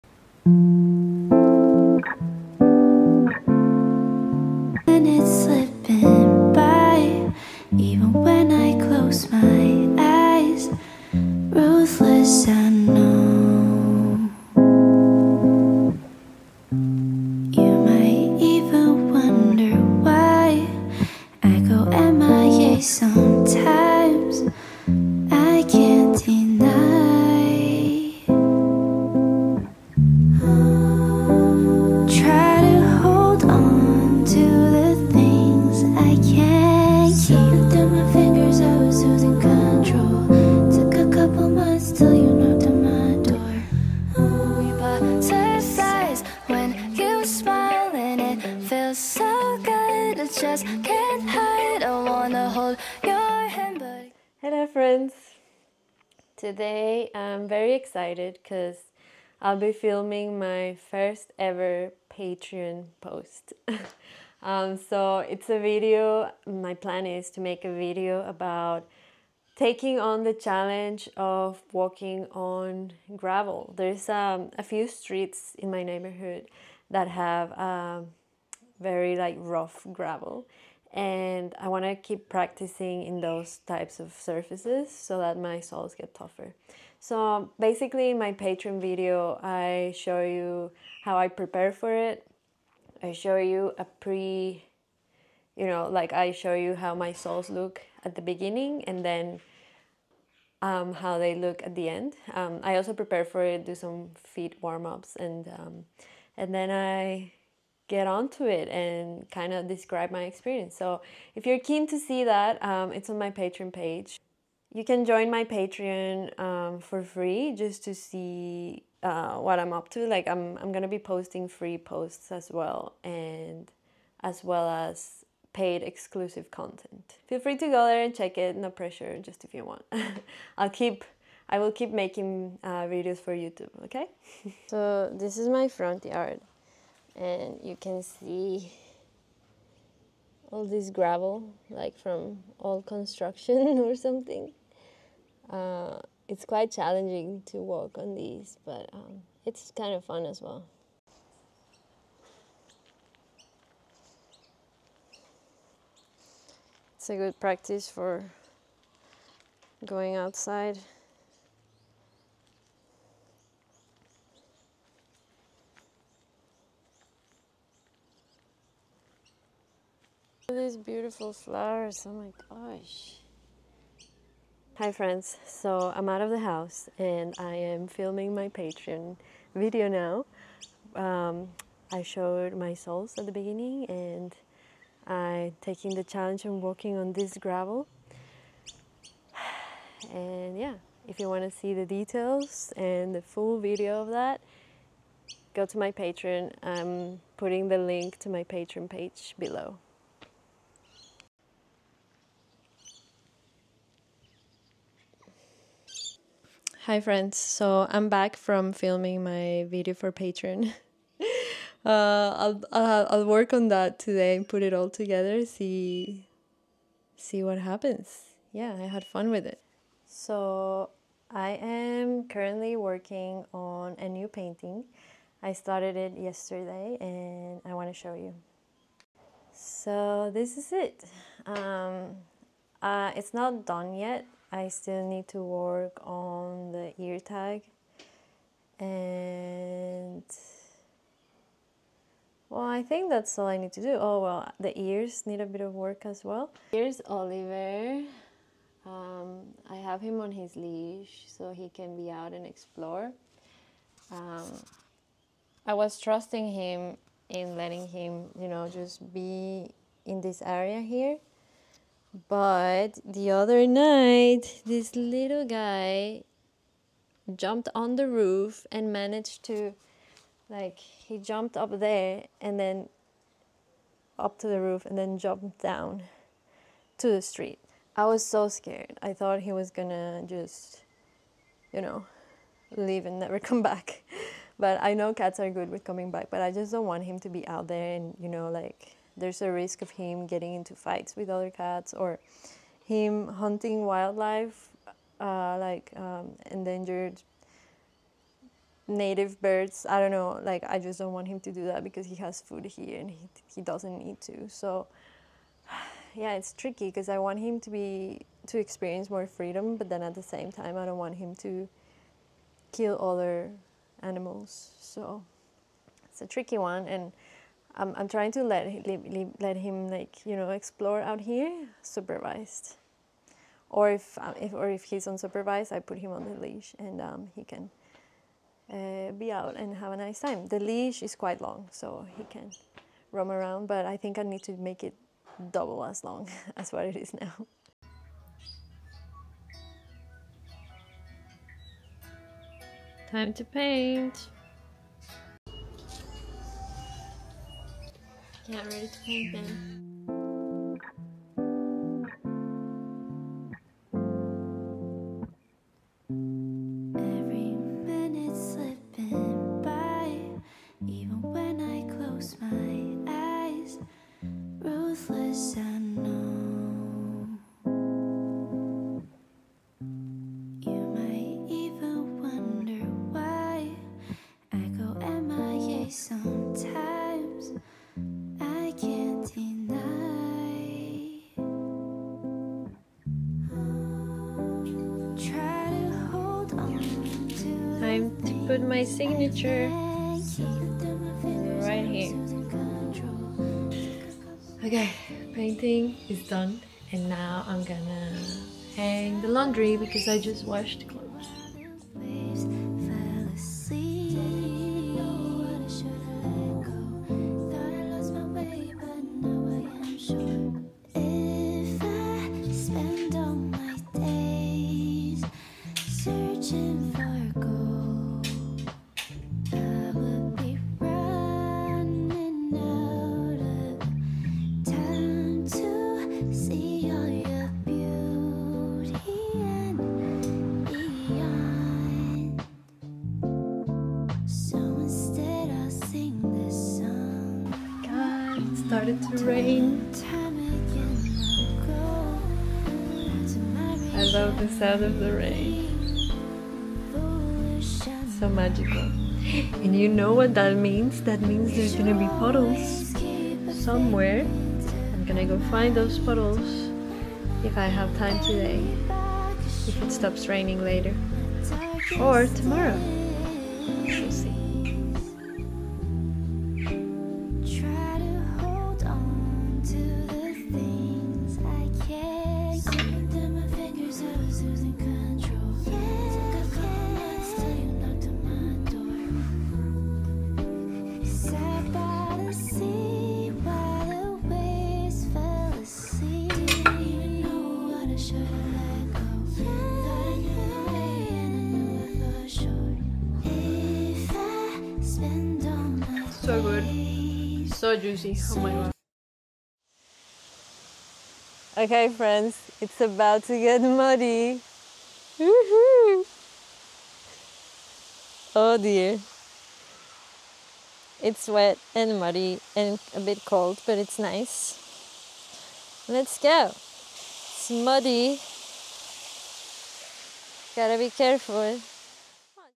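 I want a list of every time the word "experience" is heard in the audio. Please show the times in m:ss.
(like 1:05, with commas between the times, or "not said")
1:50, 5:08.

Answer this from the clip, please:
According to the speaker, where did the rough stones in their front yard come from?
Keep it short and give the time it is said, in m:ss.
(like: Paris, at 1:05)
Old construction, at 2:22.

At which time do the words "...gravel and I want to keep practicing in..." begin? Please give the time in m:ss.
1:19.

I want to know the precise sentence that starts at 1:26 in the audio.
So basically in my Patreon video I show you how I prepare for it.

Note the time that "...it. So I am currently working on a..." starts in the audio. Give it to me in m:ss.
3:39.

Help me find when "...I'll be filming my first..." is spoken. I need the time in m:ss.
0:59.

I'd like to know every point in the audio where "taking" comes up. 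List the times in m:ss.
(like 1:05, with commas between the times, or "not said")
1:09, 3:05.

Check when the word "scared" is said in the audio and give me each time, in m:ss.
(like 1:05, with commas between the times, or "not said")
4:38.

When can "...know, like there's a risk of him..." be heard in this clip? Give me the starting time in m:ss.
4:48.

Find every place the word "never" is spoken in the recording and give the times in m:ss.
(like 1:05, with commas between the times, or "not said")
4:43.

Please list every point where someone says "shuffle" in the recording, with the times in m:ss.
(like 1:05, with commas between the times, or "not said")
not said.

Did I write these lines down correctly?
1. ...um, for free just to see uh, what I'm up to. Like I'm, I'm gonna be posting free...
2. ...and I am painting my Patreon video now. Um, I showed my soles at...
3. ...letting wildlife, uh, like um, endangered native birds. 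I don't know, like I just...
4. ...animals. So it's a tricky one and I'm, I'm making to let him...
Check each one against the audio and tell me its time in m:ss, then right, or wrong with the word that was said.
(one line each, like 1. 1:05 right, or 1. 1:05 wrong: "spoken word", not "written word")
1. 1:56 right
2. 2:56 wrong: "filming", not "painting"
3. 4:53 wrong: "hunting", not "letting"
4. 5:14 wrong: "trying", not "making".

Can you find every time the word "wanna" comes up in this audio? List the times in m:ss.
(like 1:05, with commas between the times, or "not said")
0:52.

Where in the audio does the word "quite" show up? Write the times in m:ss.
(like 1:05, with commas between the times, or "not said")
2:26, 5:31.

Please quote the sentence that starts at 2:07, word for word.
Feel free to go there and check it, no pressure, just if you want.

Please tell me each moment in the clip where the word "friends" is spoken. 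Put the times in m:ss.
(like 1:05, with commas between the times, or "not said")
0:54, 2:54, 3:26, 8:21.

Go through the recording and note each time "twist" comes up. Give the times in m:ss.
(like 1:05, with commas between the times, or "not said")
not said.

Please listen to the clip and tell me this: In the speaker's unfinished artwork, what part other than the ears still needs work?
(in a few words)
Ear tag.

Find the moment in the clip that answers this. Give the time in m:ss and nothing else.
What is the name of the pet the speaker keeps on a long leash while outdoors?
4:07.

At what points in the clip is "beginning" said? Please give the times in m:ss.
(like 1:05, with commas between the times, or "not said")
1:38, 3:03.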